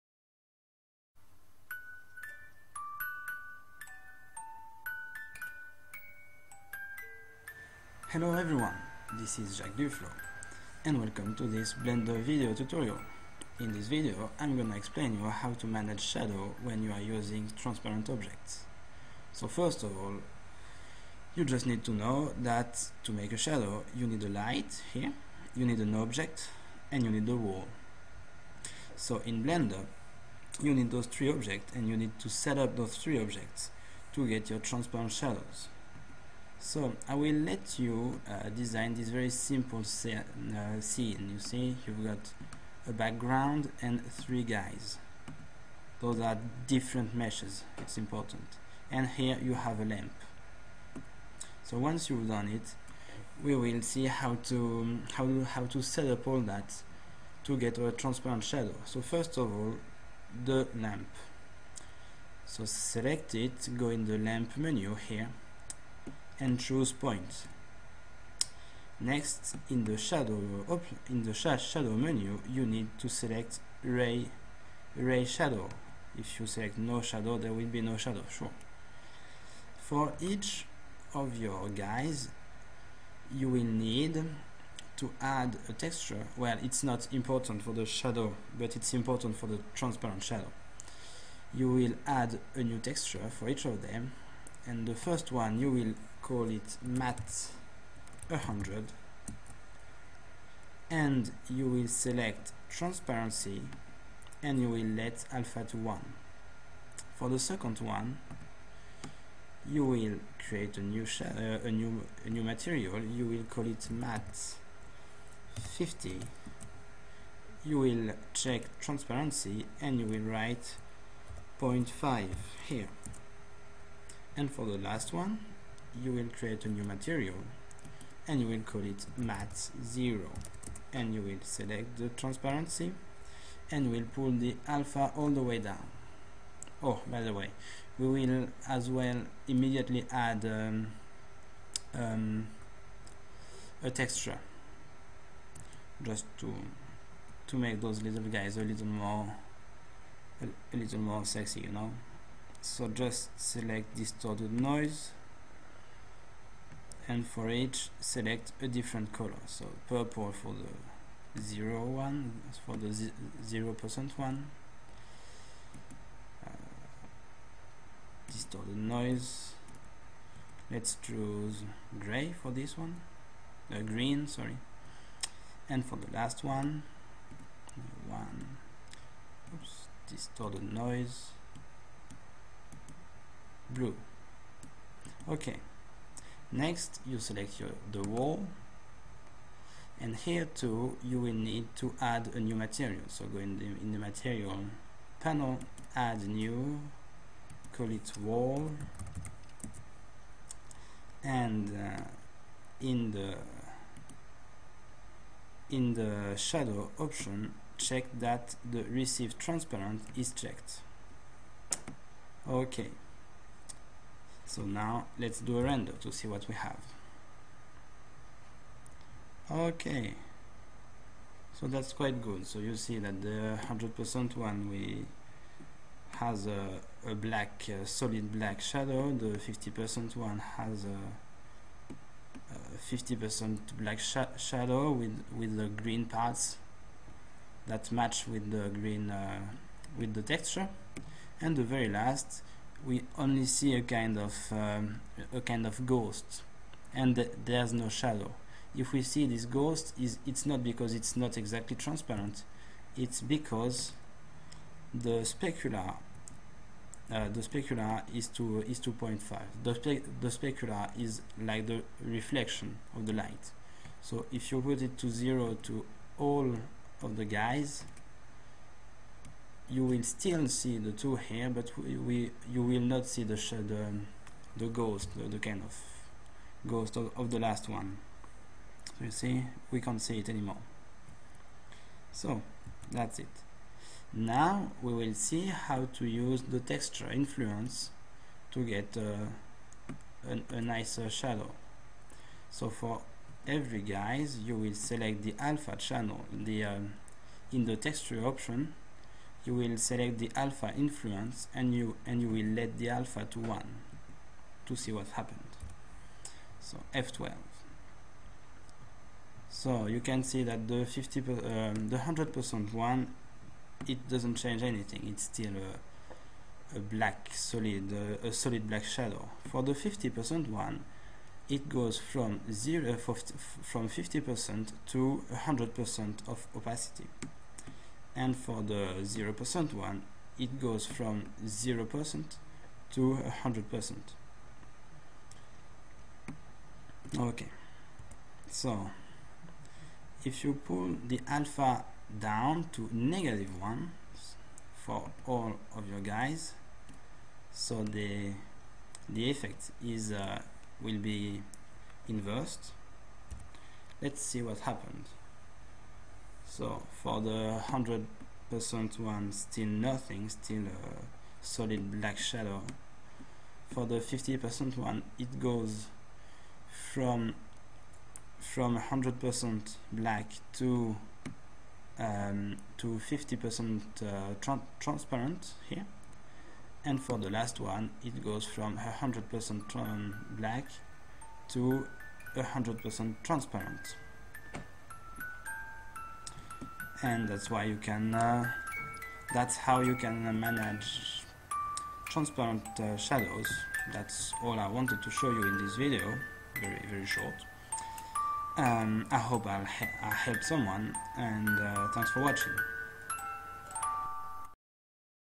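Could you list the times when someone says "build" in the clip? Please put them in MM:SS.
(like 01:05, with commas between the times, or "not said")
not said.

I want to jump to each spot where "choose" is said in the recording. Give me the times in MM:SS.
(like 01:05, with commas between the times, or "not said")
01:06, 02:51.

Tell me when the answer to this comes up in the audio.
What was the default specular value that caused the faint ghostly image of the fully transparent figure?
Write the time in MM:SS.
04:18.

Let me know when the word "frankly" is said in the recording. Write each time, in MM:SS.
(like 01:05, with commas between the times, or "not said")
not said.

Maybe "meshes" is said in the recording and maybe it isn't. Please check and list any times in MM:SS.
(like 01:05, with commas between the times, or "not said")
00:47.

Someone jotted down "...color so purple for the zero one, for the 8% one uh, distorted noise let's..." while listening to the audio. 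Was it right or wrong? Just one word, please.
wrong.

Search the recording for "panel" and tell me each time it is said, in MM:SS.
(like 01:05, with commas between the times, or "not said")
03:15.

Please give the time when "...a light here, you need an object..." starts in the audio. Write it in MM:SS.
00:24.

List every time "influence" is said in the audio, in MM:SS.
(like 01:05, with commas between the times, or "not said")
04:47, 05:00.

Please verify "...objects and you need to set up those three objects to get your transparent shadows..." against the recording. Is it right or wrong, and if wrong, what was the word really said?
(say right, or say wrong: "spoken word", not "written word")
right.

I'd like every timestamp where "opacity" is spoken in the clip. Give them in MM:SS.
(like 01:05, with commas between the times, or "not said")
05:26.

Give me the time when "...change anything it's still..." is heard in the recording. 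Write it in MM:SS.
05:14.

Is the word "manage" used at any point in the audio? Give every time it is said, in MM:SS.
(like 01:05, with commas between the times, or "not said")
00:15, 06:30.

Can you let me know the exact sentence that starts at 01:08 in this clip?
Next, in the shadow in the shadow menu, you need to select ray ray shadow.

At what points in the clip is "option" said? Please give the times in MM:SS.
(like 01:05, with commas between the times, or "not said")
03:26, 04:58.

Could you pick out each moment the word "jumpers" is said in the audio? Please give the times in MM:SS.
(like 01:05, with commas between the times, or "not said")
not said.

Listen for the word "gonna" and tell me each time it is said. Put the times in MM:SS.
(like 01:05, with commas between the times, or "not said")
00:14.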